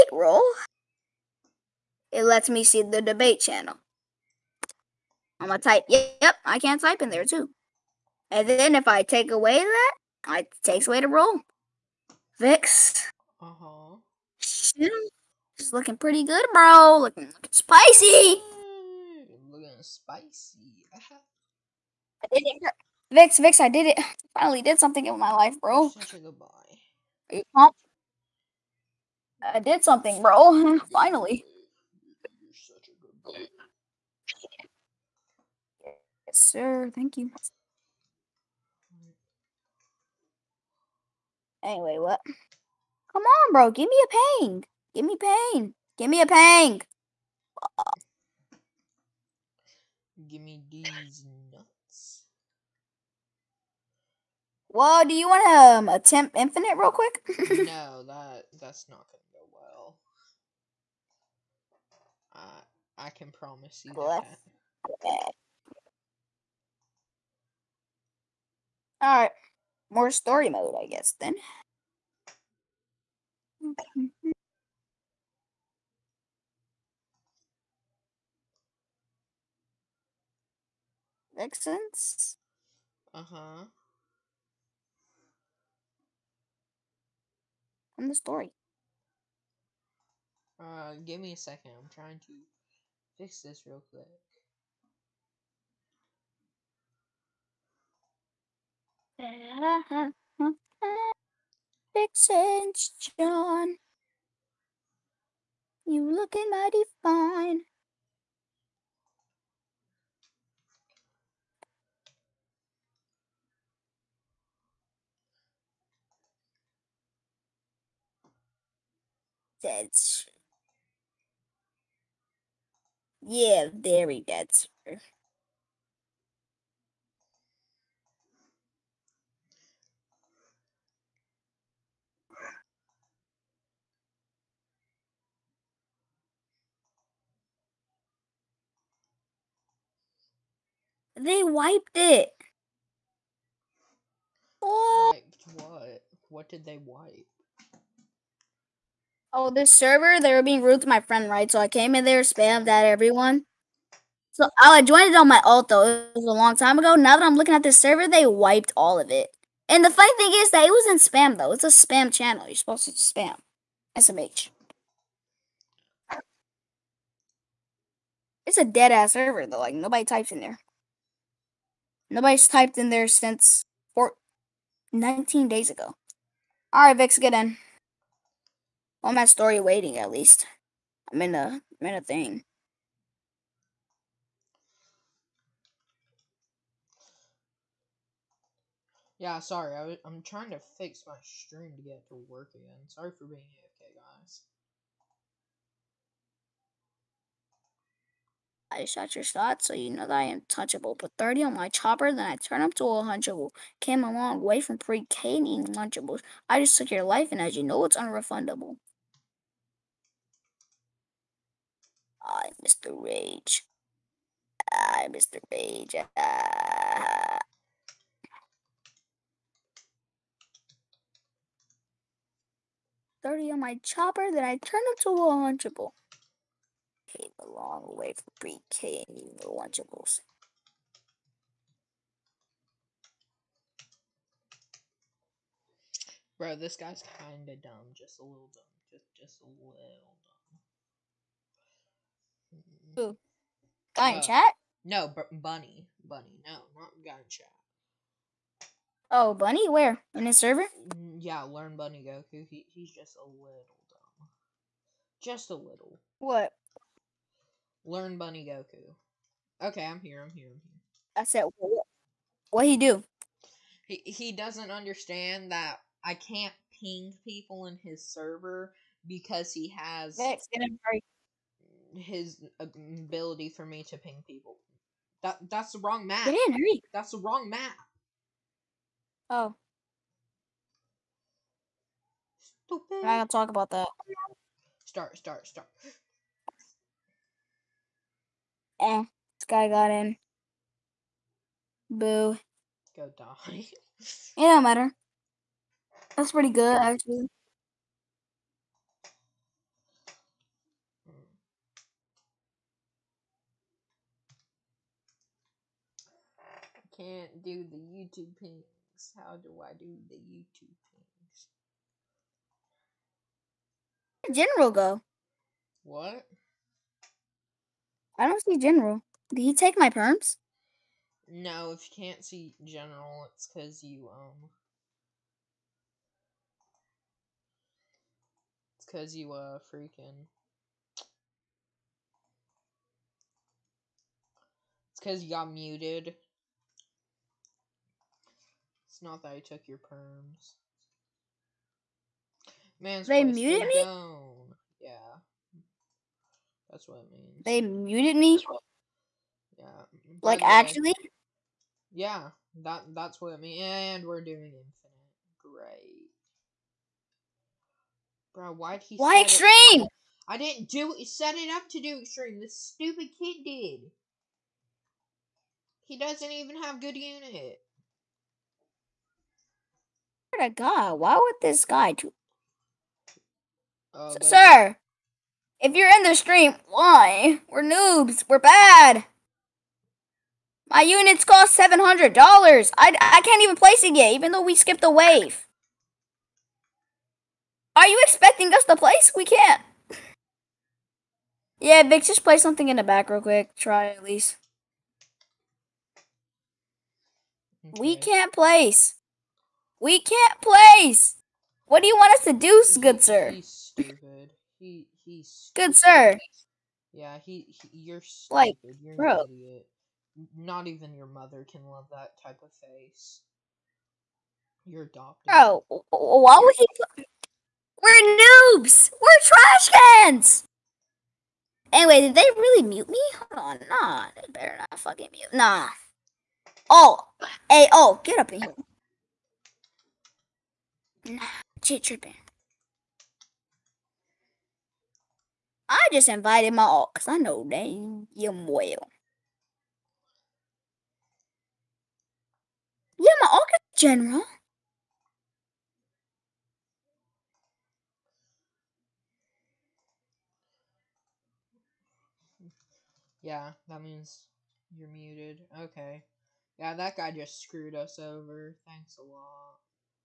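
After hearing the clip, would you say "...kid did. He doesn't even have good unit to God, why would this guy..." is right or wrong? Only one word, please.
right.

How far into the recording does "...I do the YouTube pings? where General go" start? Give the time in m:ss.
5:09.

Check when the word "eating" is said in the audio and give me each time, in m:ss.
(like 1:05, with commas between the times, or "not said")
3:25, 3:49.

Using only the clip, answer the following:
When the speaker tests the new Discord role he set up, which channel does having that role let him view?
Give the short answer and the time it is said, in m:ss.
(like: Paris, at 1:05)
debate channel, at 0:03.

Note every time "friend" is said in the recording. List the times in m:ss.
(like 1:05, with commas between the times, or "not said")
2:31.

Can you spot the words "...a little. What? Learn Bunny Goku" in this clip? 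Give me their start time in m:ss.
4:15.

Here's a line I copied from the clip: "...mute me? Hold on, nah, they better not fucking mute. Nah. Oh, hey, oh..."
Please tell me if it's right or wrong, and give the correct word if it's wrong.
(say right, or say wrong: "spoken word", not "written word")
right.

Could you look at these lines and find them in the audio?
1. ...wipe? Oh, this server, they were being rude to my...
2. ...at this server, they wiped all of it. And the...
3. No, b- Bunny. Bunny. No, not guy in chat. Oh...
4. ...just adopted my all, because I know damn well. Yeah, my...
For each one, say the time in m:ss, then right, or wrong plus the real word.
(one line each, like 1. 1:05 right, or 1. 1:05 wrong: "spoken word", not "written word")
1. 2:26 right
2. 2:37 right
3. 4:04 right
4. 7:15 wrong: "invited", not "adopted".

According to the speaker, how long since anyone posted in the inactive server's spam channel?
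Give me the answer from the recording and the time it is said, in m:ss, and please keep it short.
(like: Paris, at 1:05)
19 days, at 2:54.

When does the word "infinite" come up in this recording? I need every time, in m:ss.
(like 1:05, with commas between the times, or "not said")
0:56, 5:54.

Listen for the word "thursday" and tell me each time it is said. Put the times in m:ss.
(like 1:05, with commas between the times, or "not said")
not said.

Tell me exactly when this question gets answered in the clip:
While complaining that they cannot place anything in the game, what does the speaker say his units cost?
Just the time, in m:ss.
6:21.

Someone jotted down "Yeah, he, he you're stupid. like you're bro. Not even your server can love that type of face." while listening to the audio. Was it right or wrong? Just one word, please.
wrong.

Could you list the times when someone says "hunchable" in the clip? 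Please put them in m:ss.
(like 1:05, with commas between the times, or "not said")
3:23.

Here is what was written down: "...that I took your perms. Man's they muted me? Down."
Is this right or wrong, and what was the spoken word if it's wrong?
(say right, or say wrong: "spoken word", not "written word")
right.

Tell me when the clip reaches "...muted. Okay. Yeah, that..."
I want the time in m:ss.
7:34.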